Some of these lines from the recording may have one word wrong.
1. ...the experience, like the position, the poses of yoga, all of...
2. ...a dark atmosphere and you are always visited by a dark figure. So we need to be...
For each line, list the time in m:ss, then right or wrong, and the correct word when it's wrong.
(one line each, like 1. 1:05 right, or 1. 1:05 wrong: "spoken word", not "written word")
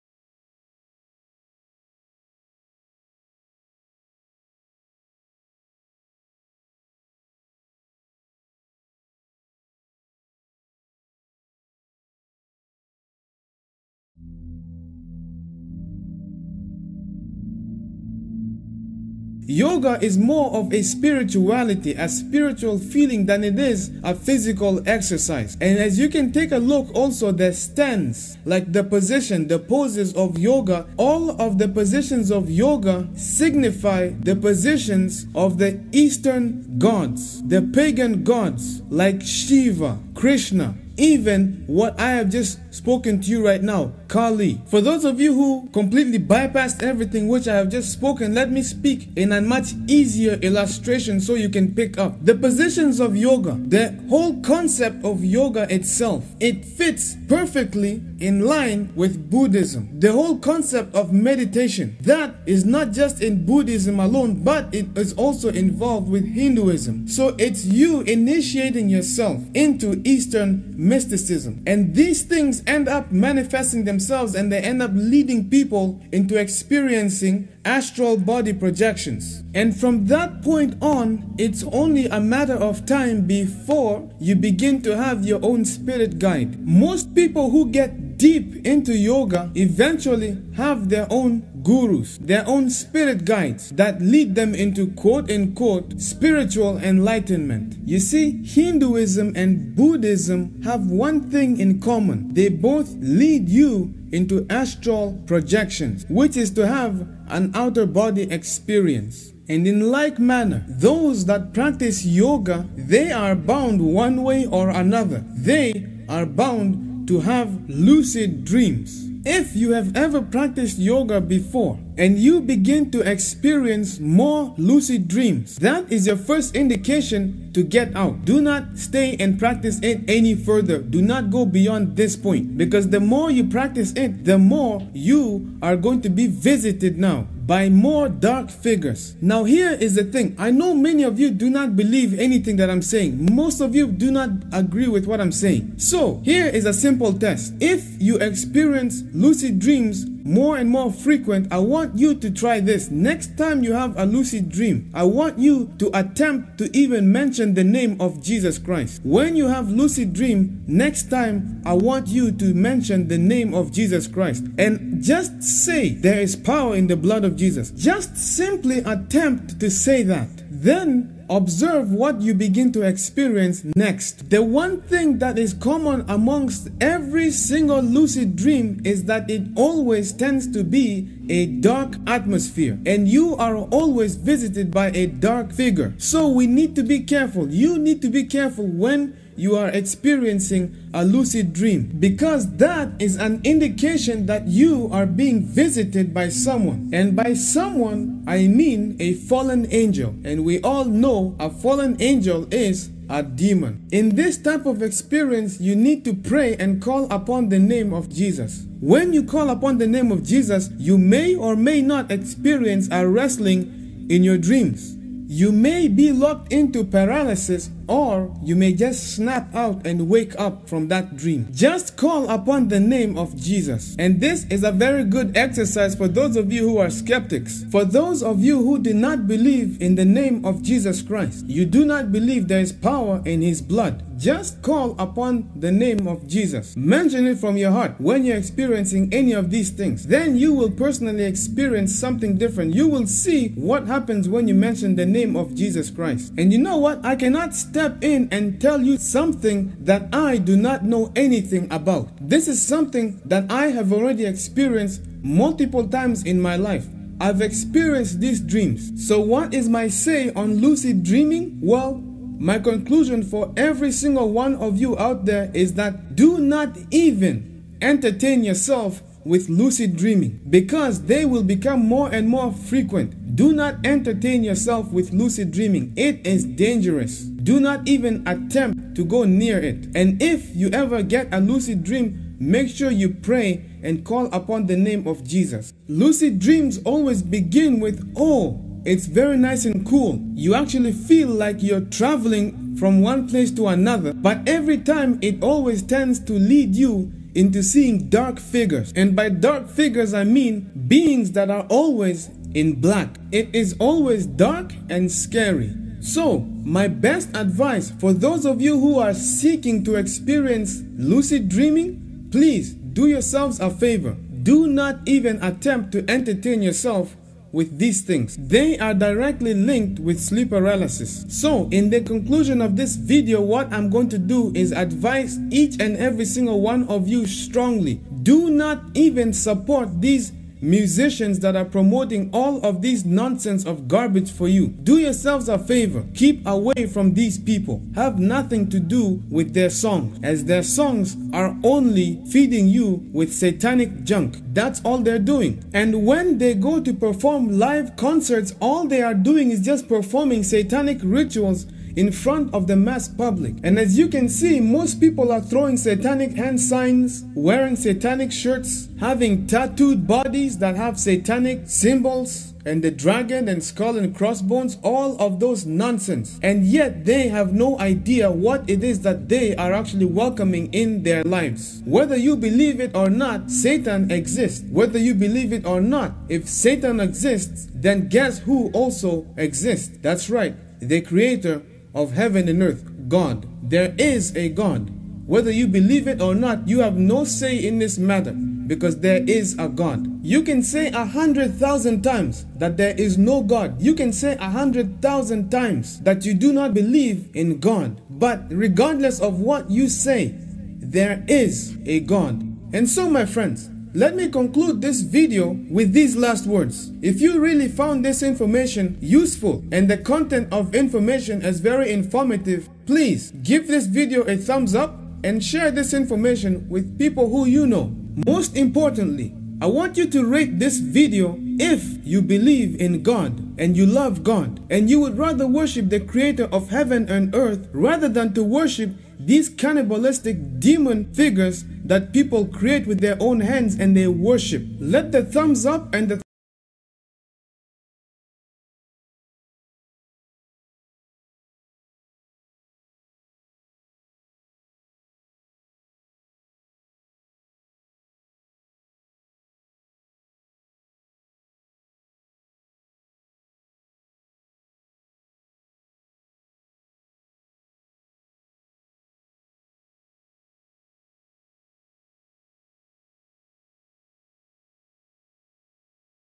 1. 0:27 wrong: "stance", not "experience"
2. 3:01 right.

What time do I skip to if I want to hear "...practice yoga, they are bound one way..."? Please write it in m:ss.
1:51.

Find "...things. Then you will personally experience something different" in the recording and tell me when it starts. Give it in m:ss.
3:59.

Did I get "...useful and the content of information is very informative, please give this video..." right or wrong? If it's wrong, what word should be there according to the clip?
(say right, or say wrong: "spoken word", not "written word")
right.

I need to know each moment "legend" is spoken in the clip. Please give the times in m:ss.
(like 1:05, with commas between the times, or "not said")
not said.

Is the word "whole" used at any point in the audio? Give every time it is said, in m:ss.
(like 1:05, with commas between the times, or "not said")
0:54, 1:00.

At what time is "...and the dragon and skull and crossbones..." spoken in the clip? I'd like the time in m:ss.
6:02.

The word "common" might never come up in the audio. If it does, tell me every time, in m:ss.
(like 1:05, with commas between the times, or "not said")
1:41, 2:55.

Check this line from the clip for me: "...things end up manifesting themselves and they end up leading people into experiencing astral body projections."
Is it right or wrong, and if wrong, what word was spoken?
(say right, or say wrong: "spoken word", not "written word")
right.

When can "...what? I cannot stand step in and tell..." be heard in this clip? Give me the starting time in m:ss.
4:06.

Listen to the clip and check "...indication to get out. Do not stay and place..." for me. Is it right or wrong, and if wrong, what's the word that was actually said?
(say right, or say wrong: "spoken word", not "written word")
wrong: "practice", not "place".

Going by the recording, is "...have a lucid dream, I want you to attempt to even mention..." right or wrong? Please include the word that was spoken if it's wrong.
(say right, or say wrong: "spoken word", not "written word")
right.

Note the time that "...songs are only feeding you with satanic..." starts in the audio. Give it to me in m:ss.
5:40.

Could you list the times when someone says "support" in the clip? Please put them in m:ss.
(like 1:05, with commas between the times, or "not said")
5:29.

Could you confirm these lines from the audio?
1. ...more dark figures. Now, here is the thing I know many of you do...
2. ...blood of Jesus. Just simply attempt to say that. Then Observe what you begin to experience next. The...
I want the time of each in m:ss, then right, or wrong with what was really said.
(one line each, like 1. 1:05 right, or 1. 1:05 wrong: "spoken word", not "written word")
1. 2:17 right
2. 2:46 right.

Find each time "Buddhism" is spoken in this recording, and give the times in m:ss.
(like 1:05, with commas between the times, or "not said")
0:59, 1:03, 1:39.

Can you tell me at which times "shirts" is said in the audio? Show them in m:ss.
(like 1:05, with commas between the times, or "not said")
5:58.